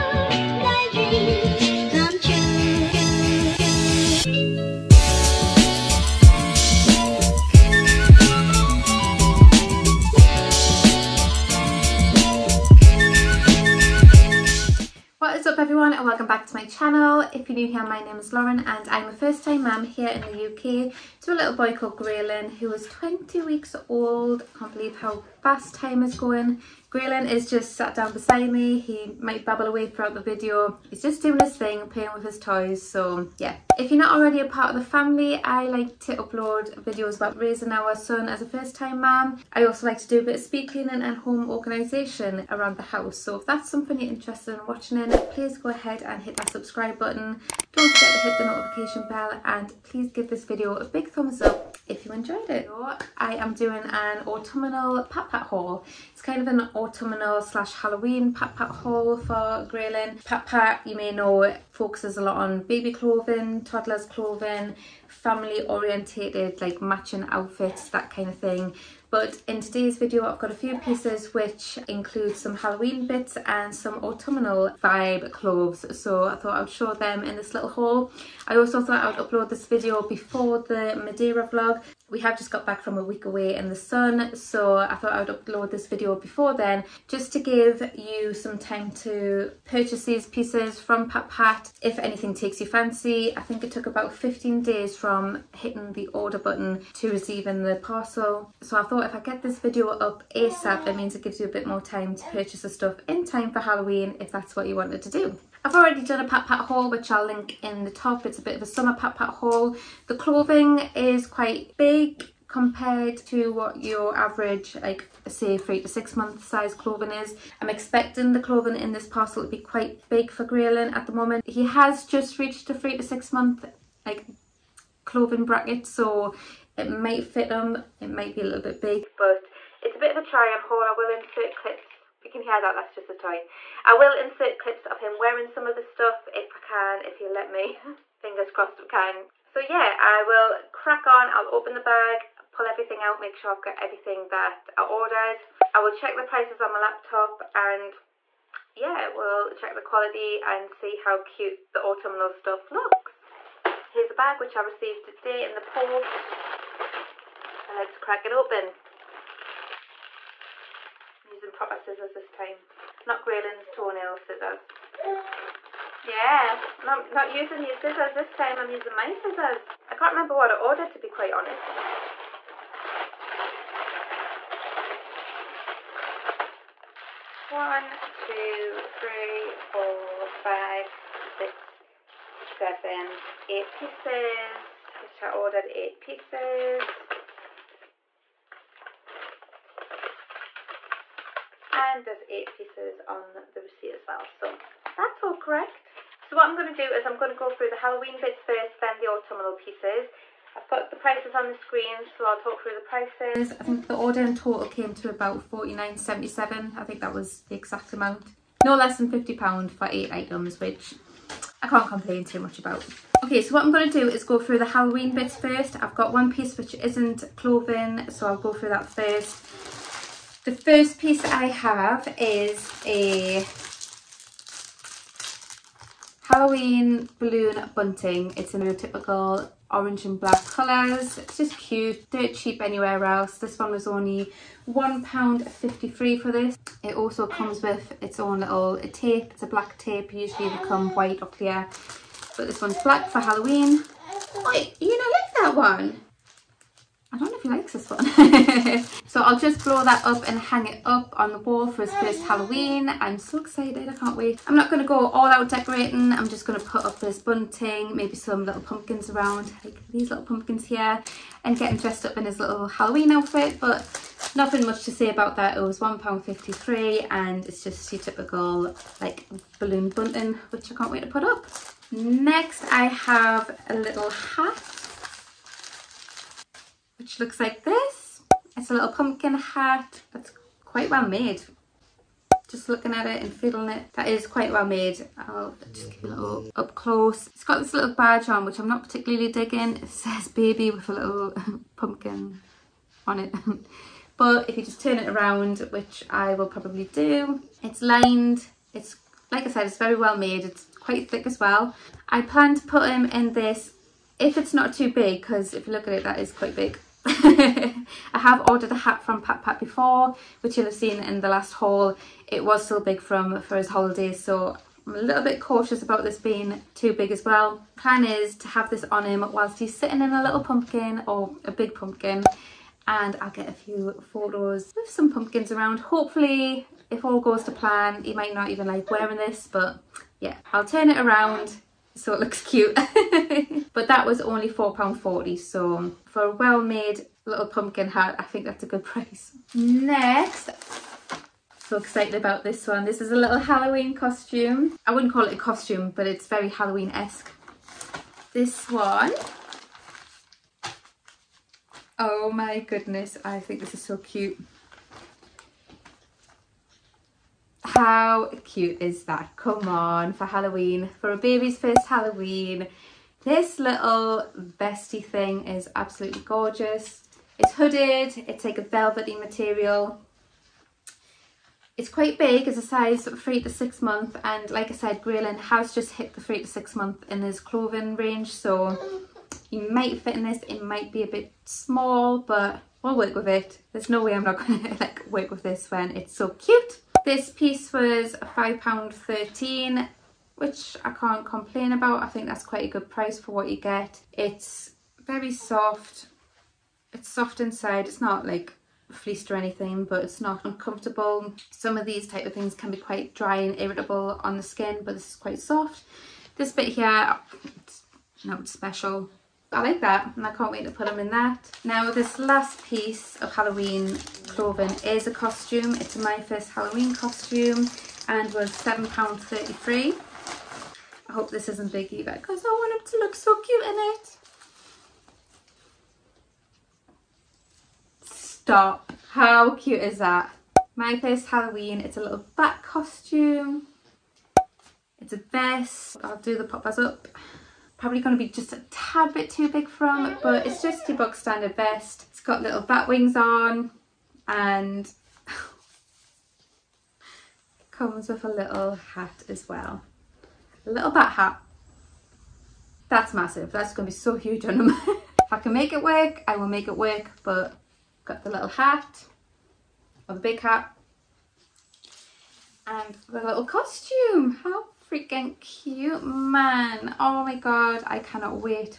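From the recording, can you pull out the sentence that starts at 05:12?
It was still big from for his holidays, so I'm a little bit cautious about this being too big as well.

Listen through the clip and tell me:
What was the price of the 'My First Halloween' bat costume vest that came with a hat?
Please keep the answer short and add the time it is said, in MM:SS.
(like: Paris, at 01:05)
£7.33, at 06:58.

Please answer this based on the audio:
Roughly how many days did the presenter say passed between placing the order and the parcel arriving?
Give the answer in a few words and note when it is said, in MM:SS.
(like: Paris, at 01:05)
15, at 01:34.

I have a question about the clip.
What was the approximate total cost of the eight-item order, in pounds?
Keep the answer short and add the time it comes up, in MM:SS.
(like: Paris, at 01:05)
£49.77, at 03:25.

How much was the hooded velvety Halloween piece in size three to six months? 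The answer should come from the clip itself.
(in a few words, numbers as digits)
£5.13.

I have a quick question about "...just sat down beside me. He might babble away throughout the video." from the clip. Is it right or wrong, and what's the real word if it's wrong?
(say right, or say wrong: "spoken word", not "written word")
right.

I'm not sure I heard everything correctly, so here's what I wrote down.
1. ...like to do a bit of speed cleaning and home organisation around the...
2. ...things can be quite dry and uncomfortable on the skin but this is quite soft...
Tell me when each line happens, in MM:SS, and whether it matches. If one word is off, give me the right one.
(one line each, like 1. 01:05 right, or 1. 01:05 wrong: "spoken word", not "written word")
1. 00:39 right
2. 06:42 wrong: "irritable", not "uncomfortable".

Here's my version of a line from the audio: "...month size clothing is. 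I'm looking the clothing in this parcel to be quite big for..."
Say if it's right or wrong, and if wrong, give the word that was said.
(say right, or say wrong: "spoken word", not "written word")
wrong: "expecting", not "looking".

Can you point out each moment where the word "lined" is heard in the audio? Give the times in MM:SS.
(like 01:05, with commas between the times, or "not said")
04:57.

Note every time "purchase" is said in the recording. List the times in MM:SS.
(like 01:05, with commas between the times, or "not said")
01:29, 01:42.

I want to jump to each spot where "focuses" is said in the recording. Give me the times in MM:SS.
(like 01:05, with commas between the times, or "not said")
01:01.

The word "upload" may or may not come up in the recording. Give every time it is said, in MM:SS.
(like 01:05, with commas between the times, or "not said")
00:36, 01:19, 01:25.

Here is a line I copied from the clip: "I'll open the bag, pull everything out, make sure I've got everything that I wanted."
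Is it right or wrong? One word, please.
wrong.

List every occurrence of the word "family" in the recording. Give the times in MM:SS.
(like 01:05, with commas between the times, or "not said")
00:34, 01:05.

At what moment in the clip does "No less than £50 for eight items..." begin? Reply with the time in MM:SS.
03:28.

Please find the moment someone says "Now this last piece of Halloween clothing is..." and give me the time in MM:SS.
06:51.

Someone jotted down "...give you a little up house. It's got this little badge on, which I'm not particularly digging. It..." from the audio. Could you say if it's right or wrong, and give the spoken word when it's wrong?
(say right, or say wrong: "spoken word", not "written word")
wrong: "close", not "house".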